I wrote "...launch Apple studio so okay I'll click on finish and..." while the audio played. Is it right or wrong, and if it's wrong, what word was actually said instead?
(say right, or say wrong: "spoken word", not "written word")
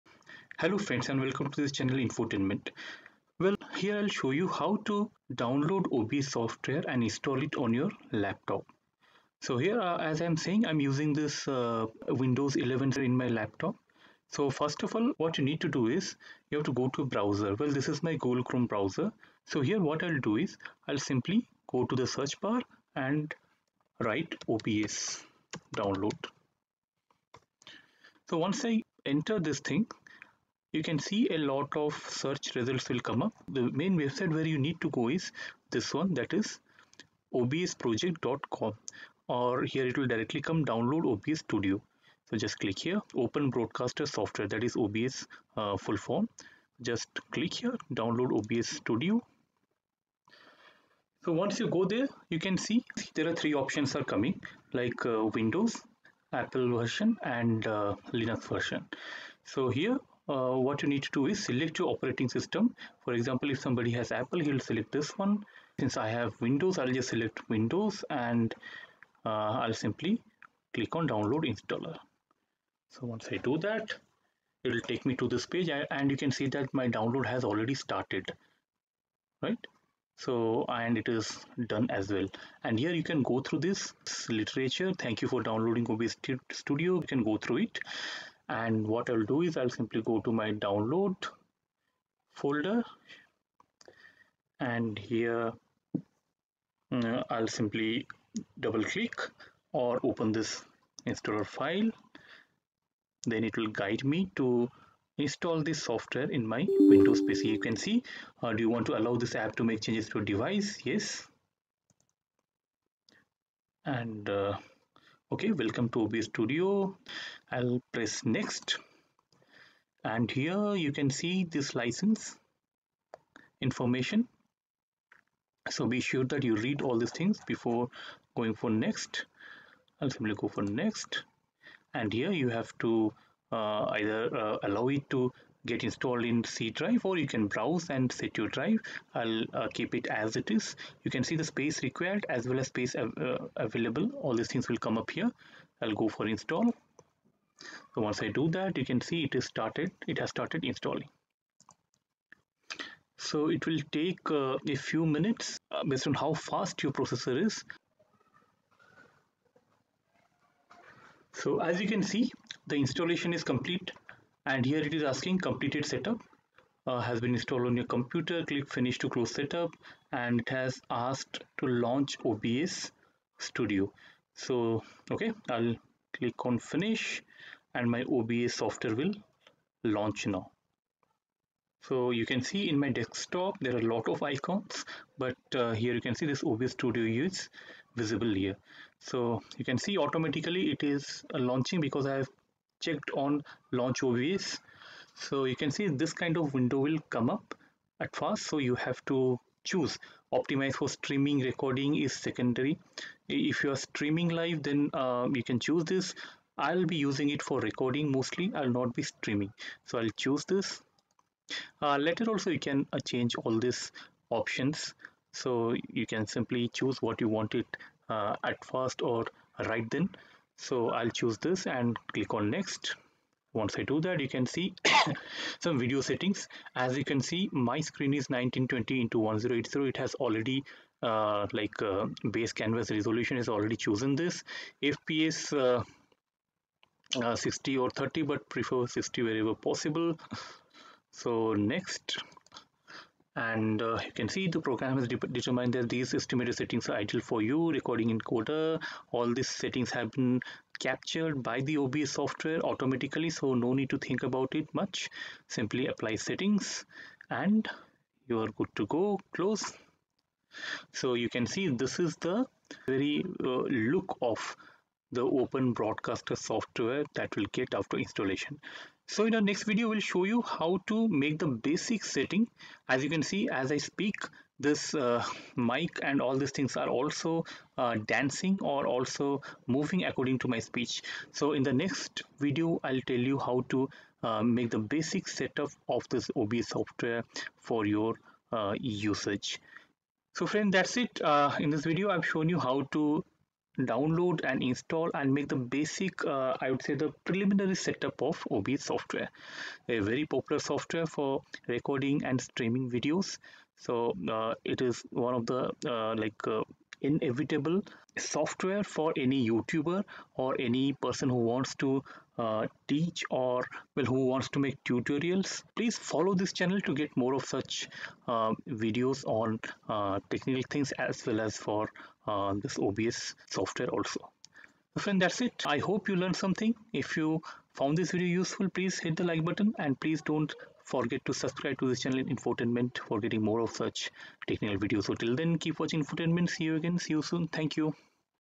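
wrong: "OBS", not "Apple".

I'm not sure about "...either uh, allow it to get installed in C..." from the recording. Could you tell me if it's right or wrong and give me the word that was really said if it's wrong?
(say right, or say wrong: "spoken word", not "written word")
right.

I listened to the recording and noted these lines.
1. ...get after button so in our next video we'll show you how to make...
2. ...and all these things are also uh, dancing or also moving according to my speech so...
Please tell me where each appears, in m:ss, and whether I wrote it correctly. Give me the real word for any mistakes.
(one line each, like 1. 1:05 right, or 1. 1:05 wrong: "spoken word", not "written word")
1. 4:27 wrong: "installation", not "button"
2. 4:36 right.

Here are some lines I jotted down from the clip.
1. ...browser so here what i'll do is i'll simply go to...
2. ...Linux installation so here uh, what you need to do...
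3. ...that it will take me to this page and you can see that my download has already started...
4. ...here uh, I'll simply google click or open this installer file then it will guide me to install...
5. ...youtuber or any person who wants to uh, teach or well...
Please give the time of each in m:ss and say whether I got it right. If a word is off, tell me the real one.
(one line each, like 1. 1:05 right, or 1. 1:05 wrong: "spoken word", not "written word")
1. 0:18 right
2. 0:58 wrong: "version", not "installation"
3. 1:13 right
4. 1:34 wrong: "double", not "google"
5. 5:09 right.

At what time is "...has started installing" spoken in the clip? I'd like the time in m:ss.
2:30.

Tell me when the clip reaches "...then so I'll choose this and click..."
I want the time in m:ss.
3:39.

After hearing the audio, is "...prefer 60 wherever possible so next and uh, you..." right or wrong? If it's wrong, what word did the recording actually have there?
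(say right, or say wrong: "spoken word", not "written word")
right.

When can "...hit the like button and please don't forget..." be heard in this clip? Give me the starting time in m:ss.
5:29.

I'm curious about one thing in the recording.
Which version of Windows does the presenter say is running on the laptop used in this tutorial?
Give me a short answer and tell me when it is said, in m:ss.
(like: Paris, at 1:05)
Windows 11, at 0:12.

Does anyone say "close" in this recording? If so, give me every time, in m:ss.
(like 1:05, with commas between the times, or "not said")
2:49, 4:19.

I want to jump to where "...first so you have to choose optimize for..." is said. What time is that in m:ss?
3:18.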